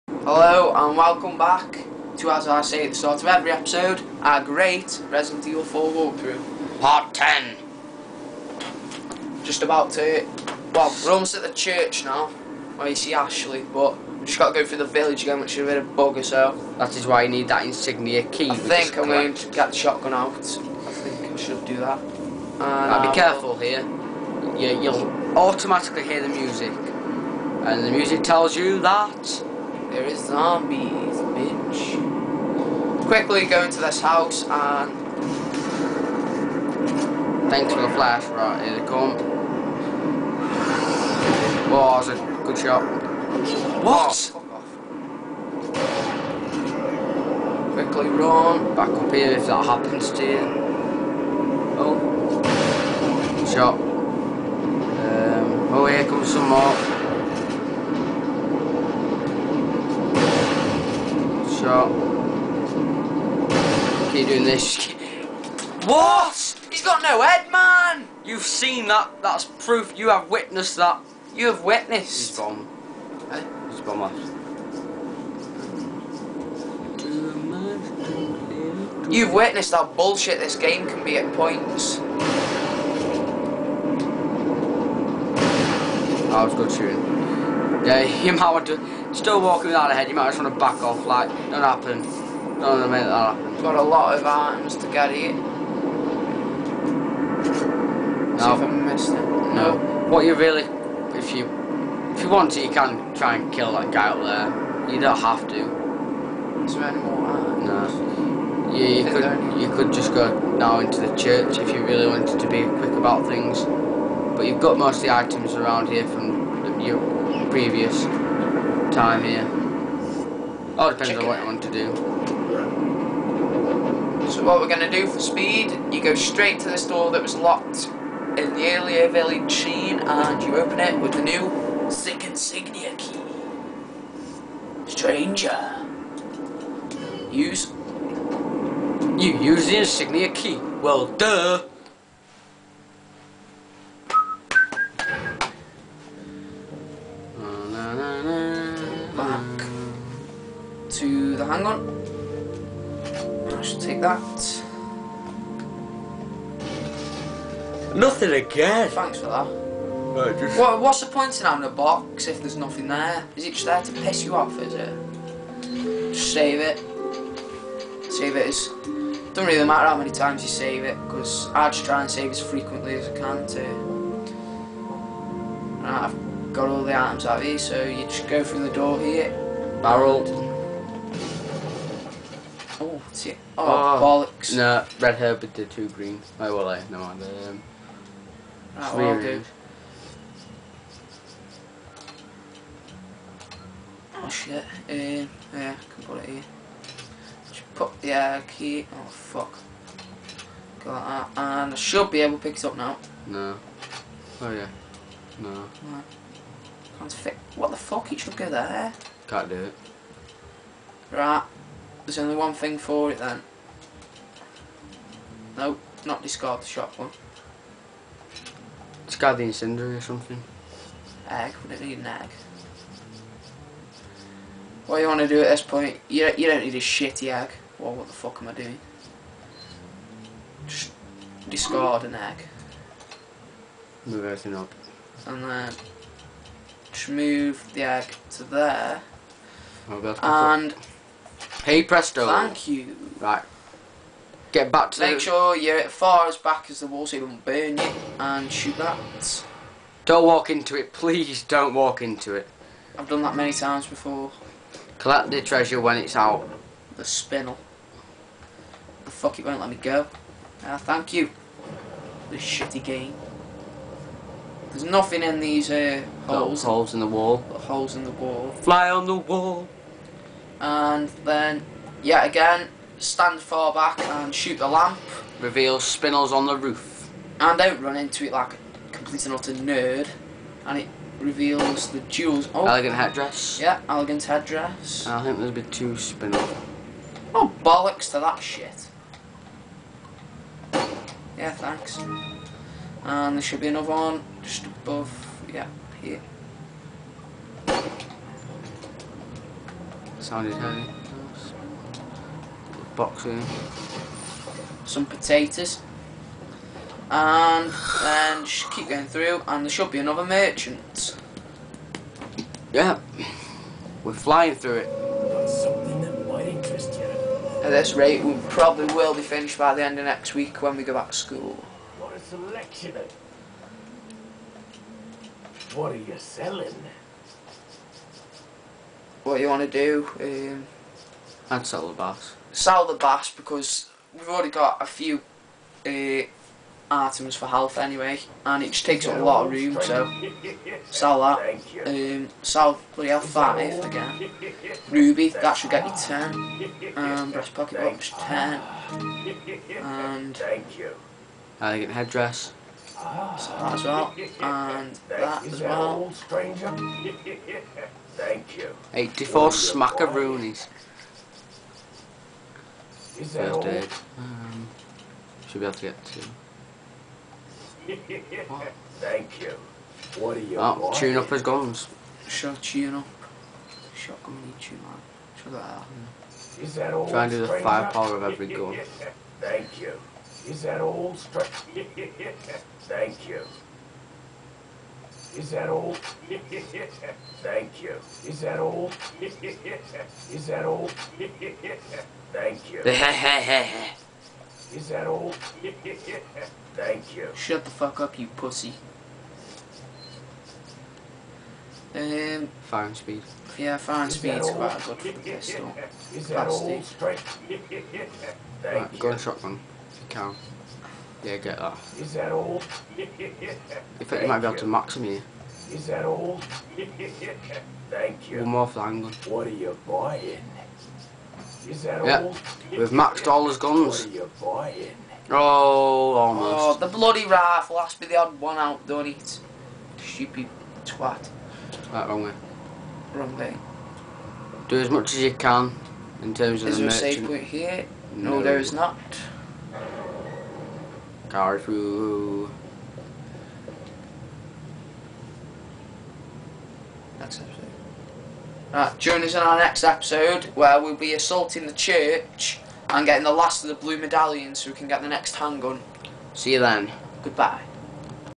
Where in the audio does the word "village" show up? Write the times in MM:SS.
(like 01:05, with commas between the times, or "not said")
00:14, 02:09.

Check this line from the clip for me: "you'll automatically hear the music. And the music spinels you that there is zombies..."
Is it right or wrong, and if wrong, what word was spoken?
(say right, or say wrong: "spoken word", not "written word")
wrong: "tells", not "spinels".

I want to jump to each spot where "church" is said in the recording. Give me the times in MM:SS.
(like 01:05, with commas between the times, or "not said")
00:11, 01:51, 07:31.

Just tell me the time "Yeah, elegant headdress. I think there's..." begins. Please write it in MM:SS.
04:43.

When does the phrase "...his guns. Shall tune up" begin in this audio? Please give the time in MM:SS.
06:11.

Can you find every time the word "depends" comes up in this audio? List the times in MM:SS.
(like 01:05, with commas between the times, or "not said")
02:00.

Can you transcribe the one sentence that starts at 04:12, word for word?
I've done that many times before.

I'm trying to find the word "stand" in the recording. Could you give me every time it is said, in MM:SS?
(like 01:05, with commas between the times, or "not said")
04:33.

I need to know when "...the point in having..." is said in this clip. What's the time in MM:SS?
02:41.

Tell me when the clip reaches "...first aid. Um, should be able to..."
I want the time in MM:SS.
06:03.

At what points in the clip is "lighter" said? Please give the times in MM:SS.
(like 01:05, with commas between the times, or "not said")
not said.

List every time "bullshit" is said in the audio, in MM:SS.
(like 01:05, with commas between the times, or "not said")
01:19.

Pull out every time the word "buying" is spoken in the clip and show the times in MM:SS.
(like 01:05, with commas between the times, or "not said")
06:59, 07:04.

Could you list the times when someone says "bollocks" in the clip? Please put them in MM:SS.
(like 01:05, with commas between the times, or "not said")
03:04, 04:47.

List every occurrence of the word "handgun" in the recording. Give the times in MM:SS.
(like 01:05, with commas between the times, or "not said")
07:35.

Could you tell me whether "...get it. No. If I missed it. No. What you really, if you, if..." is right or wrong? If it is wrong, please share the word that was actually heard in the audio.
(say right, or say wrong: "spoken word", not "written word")
right.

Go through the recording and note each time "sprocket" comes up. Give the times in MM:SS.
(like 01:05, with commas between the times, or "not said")
not said.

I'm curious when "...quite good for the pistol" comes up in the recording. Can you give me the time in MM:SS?
06:44.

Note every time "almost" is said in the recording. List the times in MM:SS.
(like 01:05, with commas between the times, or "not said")
00:11, 07:06.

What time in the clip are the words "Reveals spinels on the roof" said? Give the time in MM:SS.
04:35.